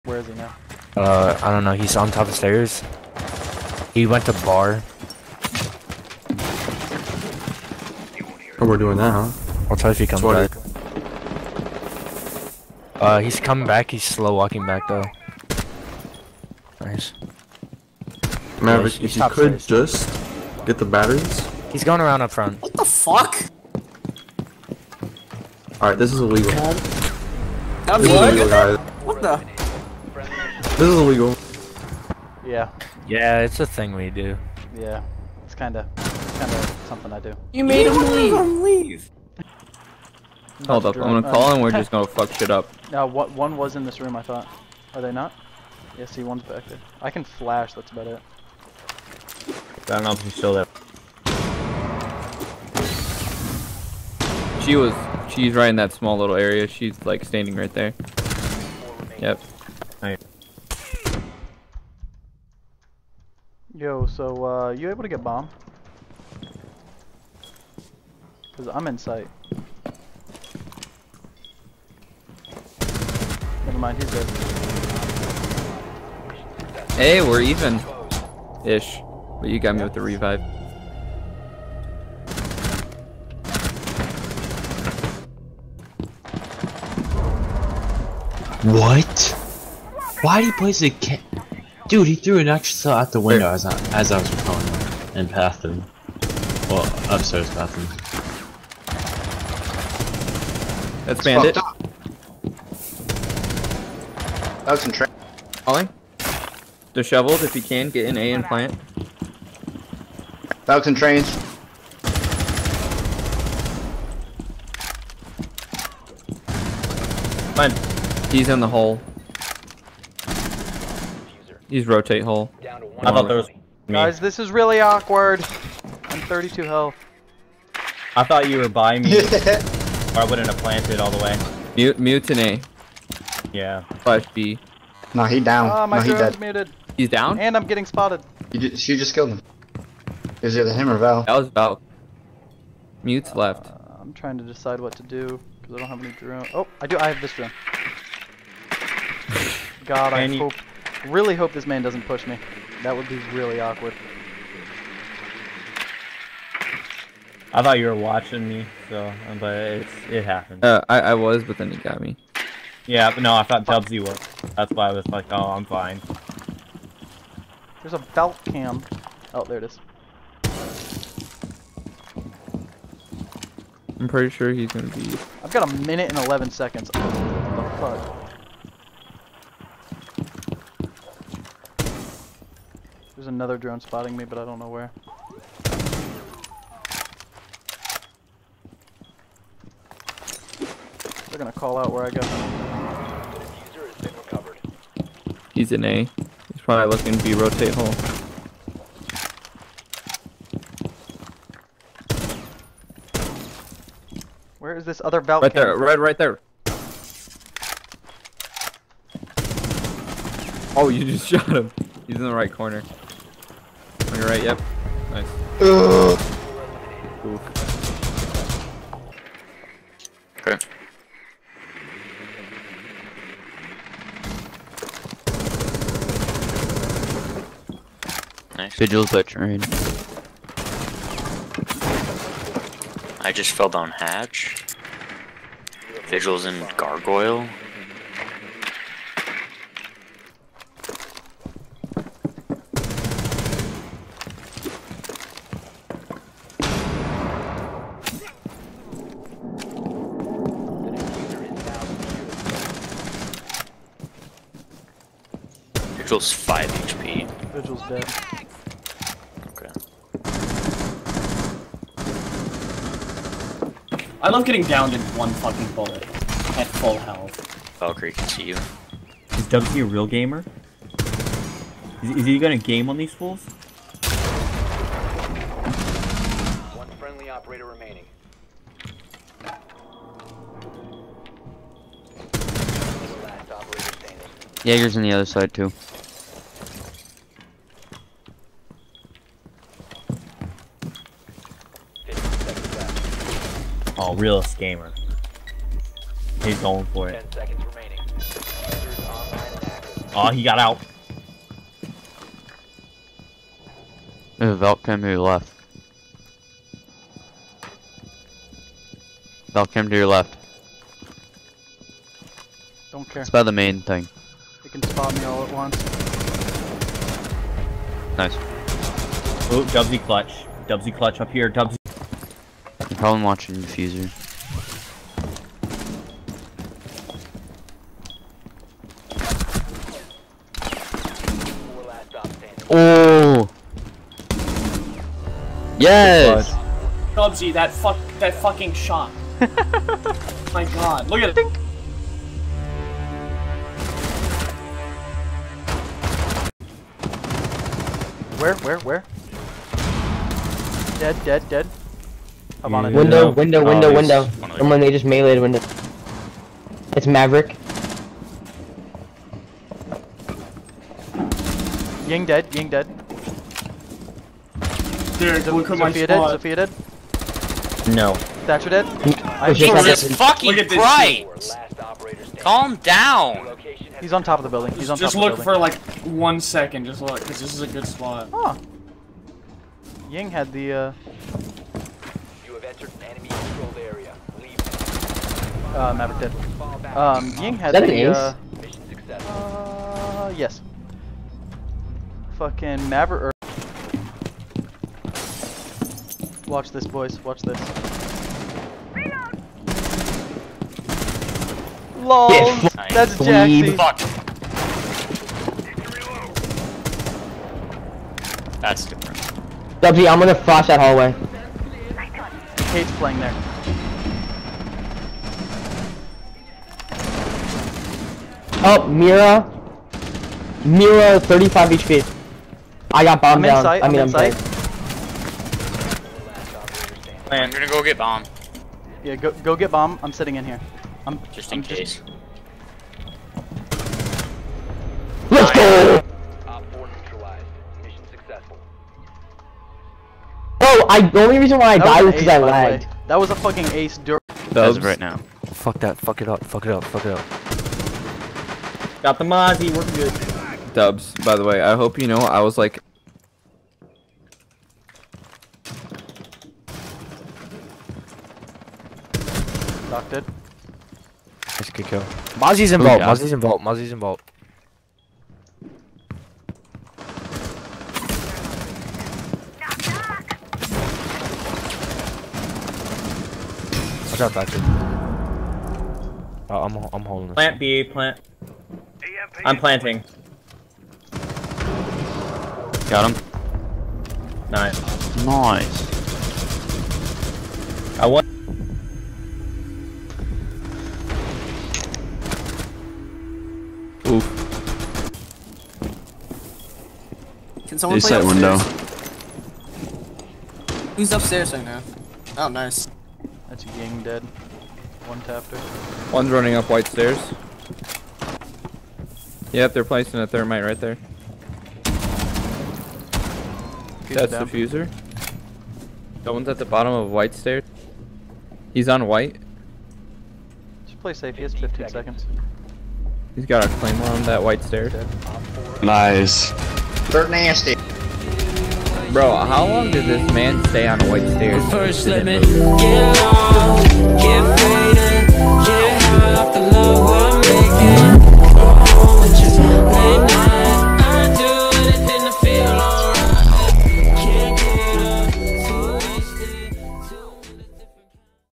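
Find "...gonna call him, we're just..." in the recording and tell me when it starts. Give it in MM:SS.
00:41.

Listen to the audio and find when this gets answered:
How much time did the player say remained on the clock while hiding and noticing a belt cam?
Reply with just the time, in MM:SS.
02:55.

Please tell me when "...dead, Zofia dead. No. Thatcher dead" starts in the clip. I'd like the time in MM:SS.
06:06.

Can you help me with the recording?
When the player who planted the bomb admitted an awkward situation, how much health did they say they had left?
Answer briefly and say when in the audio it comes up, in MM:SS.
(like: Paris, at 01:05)
32, at 02:06.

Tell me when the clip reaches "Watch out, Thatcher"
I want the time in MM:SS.
07:54.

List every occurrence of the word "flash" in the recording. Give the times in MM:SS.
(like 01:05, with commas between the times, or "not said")
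00:47, 06:50.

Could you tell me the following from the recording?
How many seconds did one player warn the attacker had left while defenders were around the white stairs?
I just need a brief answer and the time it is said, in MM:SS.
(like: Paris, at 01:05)
15, at 08:41.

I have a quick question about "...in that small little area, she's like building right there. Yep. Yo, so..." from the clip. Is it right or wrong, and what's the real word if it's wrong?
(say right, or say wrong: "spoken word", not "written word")
wrong: "standing", not "building".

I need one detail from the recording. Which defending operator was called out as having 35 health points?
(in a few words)
Mira.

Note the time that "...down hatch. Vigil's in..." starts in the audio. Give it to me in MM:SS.
03:53.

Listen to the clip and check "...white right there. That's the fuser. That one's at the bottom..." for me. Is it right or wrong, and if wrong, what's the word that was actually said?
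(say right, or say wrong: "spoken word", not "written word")
wrong: "thermite", not "white".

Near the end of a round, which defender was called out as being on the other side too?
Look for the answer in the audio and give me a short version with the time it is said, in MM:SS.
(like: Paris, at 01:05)
Jaeger, at 04:44.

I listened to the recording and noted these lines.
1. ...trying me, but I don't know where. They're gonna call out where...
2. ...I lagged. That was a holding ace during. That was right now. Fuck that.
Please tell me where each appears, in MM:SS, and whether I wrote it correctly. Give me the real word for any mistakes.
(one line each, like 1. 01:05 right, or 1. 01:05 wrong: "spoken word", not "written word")
1. 03:03 wrong: "spotting", not "trying"
2. 07:22 wrong: "fucking", not "holding".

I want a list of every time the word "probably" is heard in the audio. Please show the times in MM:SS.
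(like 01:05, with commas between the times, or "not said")
03:16, 05:23.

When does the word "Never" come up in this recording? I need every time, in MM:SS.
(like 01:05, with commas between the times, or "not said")
01:13.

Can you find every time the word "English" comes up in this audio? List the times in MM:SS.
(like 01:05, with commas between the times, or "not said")
not said.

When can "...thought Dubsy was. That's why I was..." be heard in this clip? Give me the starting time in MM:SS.
02:43.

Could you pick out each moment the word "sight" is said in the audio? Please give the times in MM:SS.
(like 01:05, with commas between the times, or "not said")
01:08.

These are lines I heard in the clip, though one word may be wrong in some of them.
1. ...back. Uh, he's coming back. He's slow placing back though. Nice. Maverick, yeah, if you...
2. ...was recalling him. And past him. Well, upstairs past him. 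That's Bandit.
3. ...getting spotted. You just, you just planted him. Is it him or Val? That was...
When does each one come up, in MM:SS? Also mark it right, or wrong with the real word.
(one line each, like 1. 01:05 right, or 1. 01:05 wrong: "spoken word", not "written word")
1. 00:10 wrong: "walking", not "placing"
2. 01:34 right
3. 02:17 wrong: "killed", not "planted".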